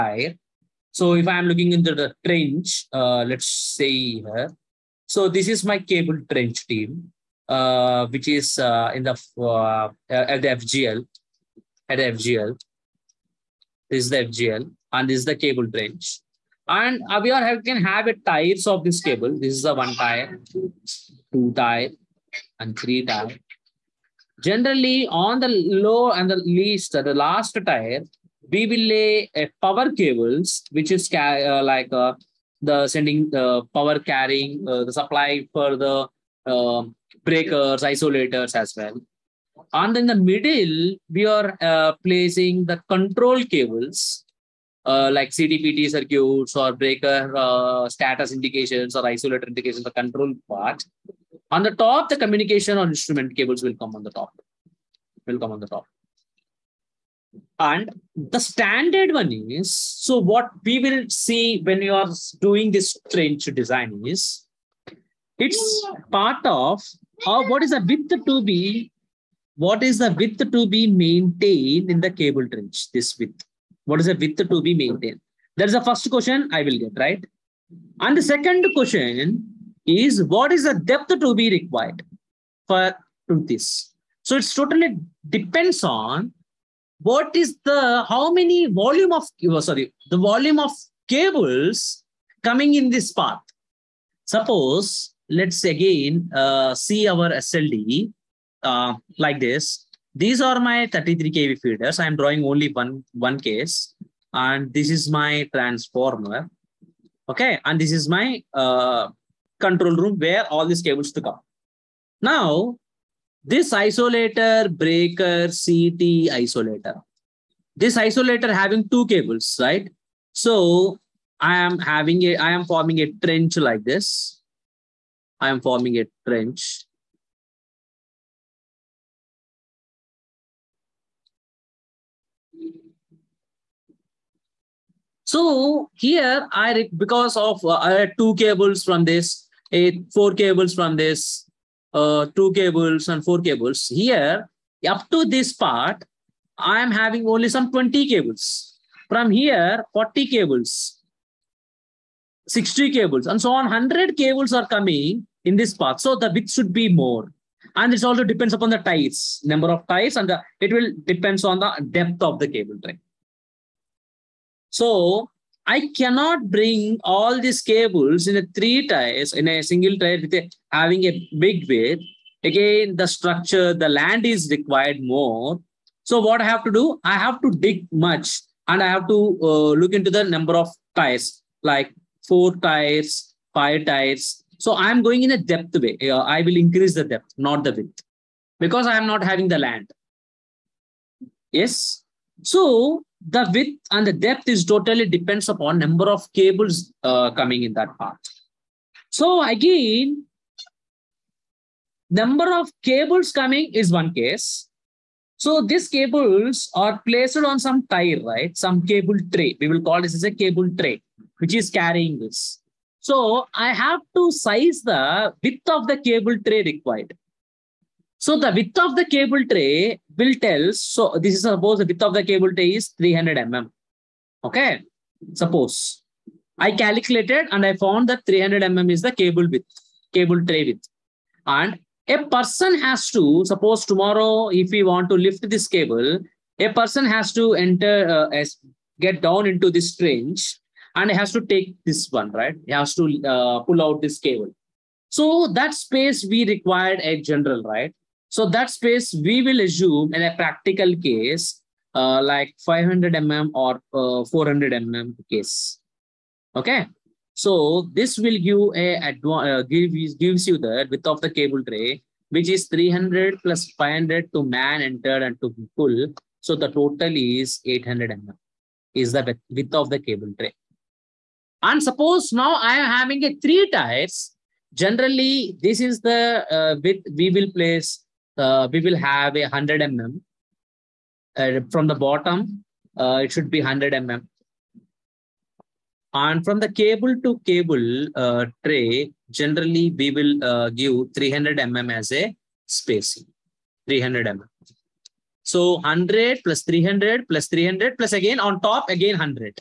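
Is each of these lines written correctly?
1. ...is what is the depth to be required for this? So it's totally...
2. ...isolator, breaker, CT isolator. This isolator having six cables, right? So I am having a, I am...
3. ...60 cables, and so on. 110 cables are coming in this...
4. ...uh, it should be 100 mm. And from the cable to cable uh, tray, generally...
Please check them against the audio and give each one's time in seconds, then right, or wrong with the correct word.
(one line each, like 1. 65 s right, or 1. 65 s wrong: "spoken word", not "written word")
1. 79 s right
2. 113 s wrong: "two", not "six"
3. 152 s wrong: "100", not "110"
4. 282 s right.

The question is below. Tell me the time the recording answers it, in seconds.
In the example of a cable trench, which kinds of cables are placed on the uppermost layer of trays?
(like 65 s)
52 s.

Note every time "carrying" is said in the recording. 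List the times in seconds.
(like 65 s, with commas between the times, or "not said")
33 s, 211 s.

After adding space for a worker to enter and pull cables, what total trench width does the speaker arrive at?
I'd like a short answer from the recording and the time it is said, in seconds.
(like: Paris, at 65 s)
800 mm, at 267 s.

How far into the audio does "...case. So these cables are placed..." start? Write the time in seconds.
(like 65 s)
204 s.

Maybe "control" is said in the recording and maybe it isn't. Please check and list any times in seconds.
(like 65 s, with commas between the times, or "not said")
42 s, 49 s, 109 s.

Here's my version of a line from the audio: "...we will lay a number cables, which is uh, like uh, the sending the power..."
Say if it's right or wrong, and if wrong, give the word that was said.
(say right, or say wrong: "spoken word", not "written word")
wrong: "power", not "number".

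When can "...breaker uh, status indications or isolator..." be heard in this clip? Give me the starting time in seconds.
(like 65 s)
46 s.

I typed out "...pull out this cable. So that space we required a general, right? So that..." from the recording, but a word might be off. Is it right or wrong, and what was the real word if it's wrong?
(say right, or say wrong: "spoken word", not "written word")
right.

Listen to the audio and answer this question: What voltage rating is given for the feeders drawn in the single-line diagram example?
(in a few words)
33 kV.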